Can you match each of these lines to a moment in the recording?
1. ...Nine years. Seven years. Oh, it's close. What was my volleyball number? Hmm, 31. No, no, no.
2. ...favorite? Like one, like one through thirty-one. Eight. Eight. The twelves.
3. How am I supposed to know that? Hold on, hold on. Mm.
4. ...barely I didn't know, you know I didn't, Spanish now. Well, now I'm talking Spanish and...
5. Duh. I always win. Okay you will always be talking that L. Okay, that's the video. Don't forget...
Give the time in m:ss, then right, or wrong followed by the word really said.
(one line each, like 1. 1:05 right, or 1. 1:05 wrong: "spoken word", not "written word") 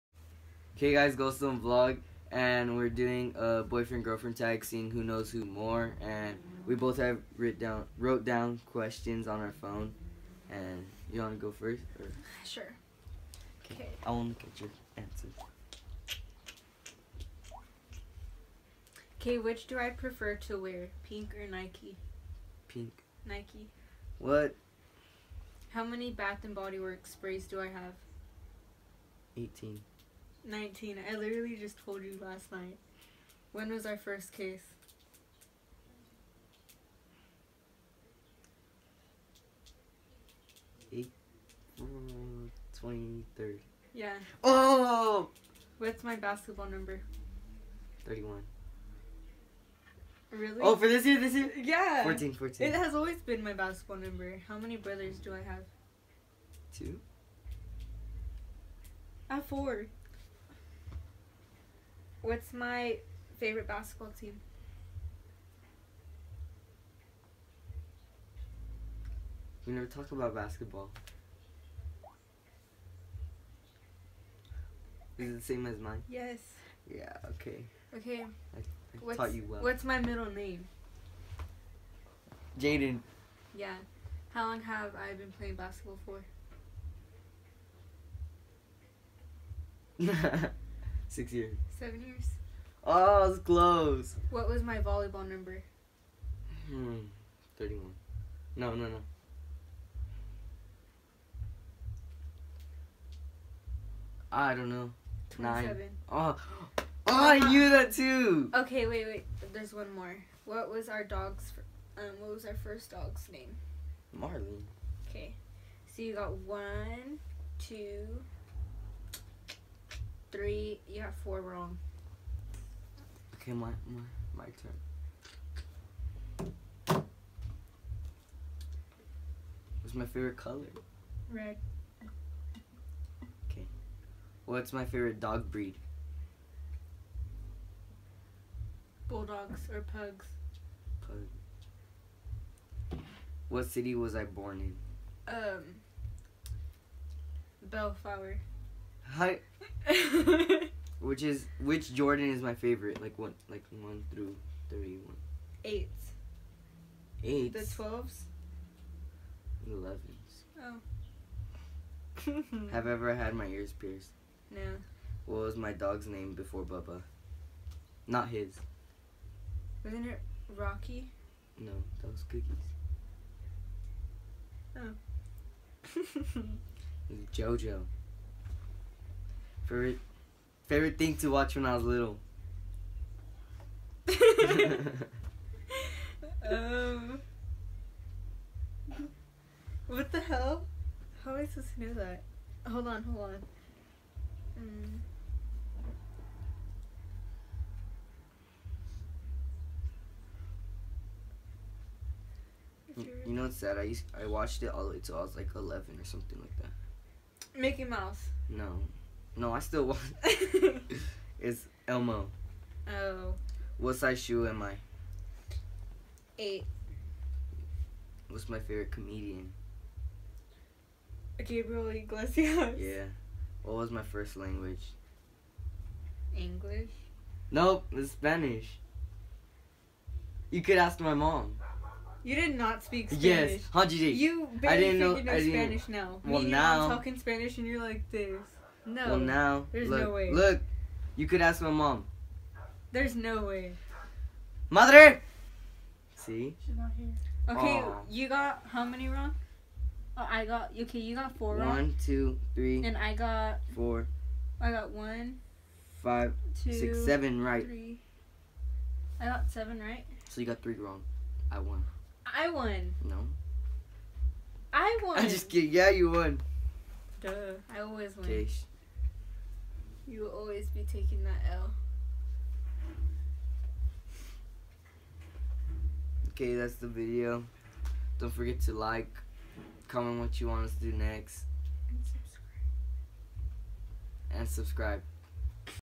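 1. 1:31 wrong: "Six", not "Nine"
2. 2:32 right
3. 3:11 right
4. 3:54 right
5. 4:27 wrong: "taking", not "talking".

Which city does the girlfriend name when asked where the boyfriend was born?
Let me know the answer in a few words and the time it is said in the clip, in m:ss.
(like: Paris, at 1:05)
Bellflower, at 2:27.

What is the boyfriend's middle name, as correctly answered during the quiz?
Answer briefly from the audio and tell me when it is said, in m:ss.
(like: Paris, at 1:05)
Jaden, at 1:22.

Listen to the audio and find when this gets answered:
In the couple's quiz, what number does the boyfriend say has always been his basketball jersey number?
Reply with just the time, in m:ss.
0:52.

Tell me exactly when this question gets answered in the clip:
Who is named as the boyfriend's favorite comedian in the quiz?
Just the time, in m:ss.
3:41.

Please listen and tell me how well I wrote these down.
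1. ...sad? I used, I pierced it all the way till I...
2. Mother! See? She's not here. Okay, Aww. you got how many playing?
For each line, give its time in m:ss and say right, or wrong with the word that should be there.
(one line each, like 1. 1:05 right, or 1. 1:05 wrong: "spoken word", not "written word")
1. 3:23 wrong: "watched", not "pierced"
2. 4:04 wrong: "wrong", not "playing".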